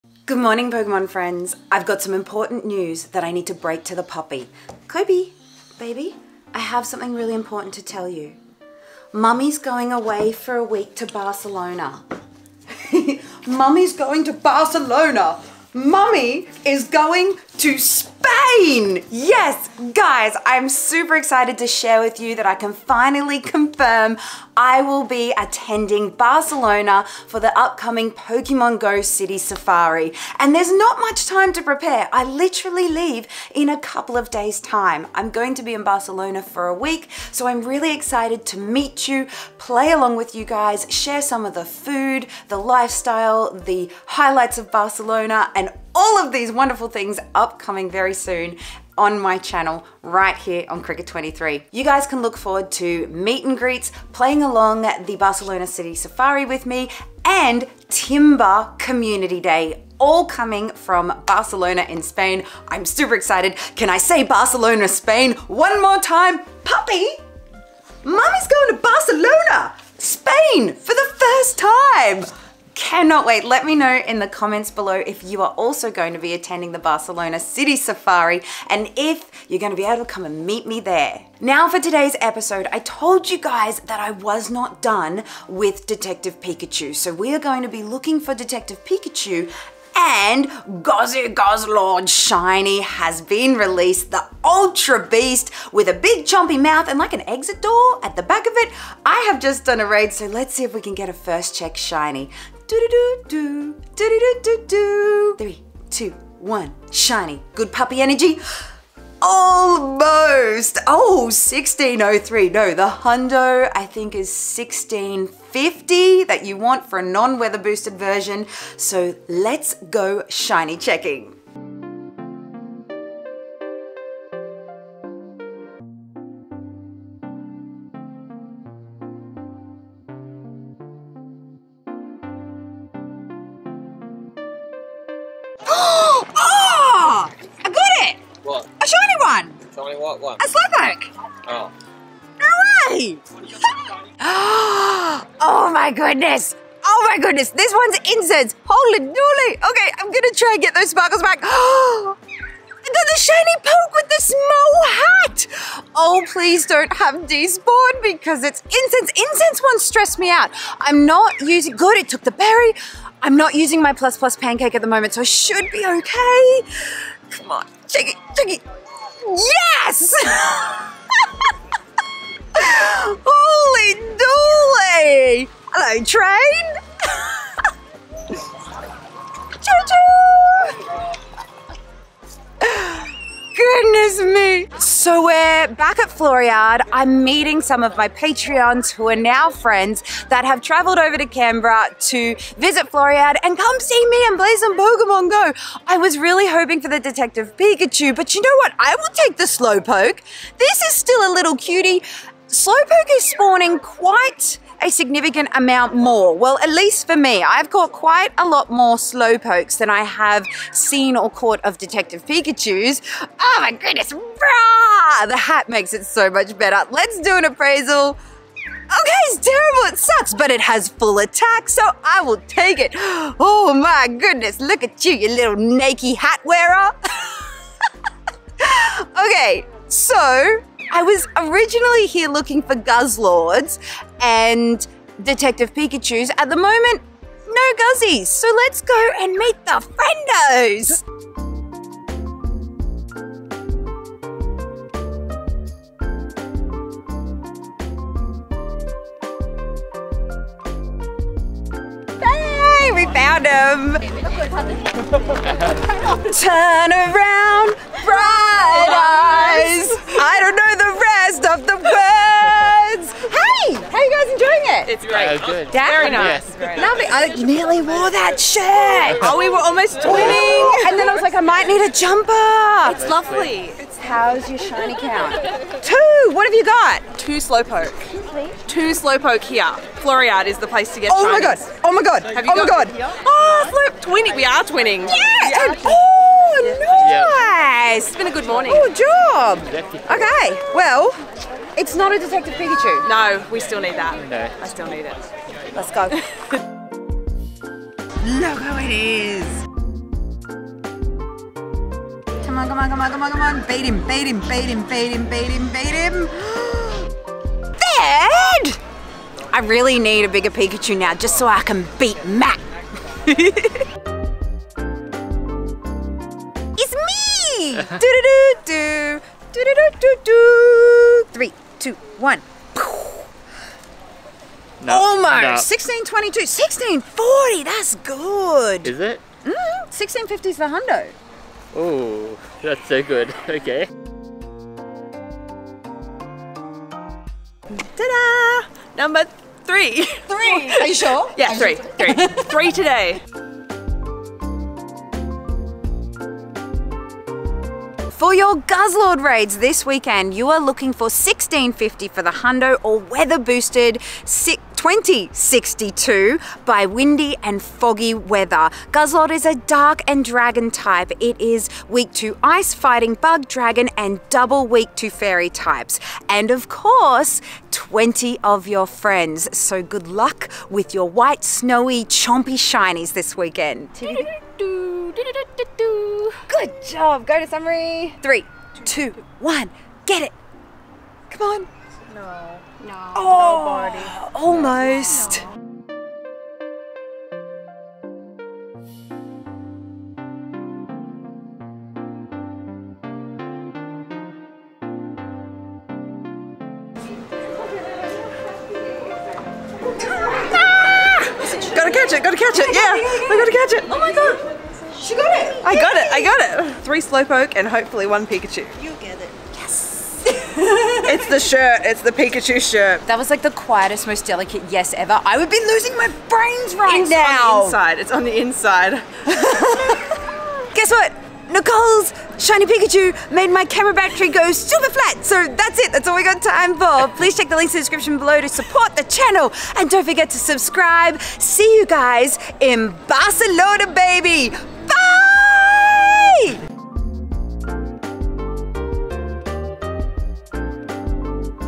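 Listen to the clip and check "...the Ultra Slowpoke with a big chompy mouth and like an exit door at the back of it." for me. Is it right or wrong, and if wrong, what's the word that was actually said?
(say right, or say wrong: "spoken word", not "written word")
wrong: "Beast", not "Slowpoke".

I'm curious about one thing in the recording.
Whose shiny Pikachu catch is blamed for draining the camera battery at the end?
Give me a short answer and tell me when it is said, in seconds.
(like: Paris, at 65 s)
Nicole, at 421 s.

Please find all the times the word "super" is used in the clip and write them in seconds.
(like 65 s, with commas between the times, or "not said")
20 s, 62 s, 424 s.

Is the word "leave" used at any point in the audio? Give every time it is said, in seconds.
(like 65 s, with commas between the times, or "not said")
32 s.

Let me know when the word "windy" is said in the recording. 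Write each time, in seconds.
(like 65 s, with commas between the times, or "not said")
356 s.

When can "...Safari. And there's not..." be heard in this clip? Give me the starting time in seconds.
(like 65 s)
29 s.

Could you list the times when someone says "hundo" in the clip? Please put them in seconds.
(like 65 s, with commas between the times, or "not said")
112 s, 330 s, 352 s.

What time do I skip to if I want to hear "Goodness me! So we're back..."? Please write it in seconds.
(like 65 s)
183 s.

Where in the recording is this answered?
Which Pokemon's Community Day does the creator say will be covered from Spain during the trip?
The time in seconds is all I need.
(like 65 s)
57 s.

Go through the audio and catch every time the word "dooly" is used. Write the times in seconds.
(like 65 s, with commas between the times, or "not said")
148 s, 173 s.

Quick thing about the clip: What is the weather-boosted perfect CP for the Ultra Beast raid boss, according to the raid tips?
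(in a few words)
2062.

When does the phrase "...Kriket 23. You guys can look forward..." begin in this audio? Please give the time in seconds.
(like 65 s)
50 s.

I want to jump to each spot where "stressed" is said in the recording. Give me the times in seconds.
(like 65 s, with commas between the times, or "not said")
159 s.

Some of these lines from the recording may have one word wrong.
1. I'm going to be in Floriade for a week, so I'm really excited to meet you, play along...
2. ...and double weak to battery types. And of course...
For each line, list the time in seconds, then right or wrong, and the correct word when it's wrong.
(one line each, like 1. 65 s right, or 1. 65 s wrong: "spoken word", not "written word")
1. 35 s wrong: "Barcelona", not "Floriade"
2. 363 s wrong: "fairy", not "battery".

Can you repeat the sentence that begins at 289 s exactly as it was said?
Okay, well, it's not a Detective Pikachu.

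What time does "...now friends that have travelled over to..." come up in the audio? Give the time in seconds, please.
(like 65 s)
189 s.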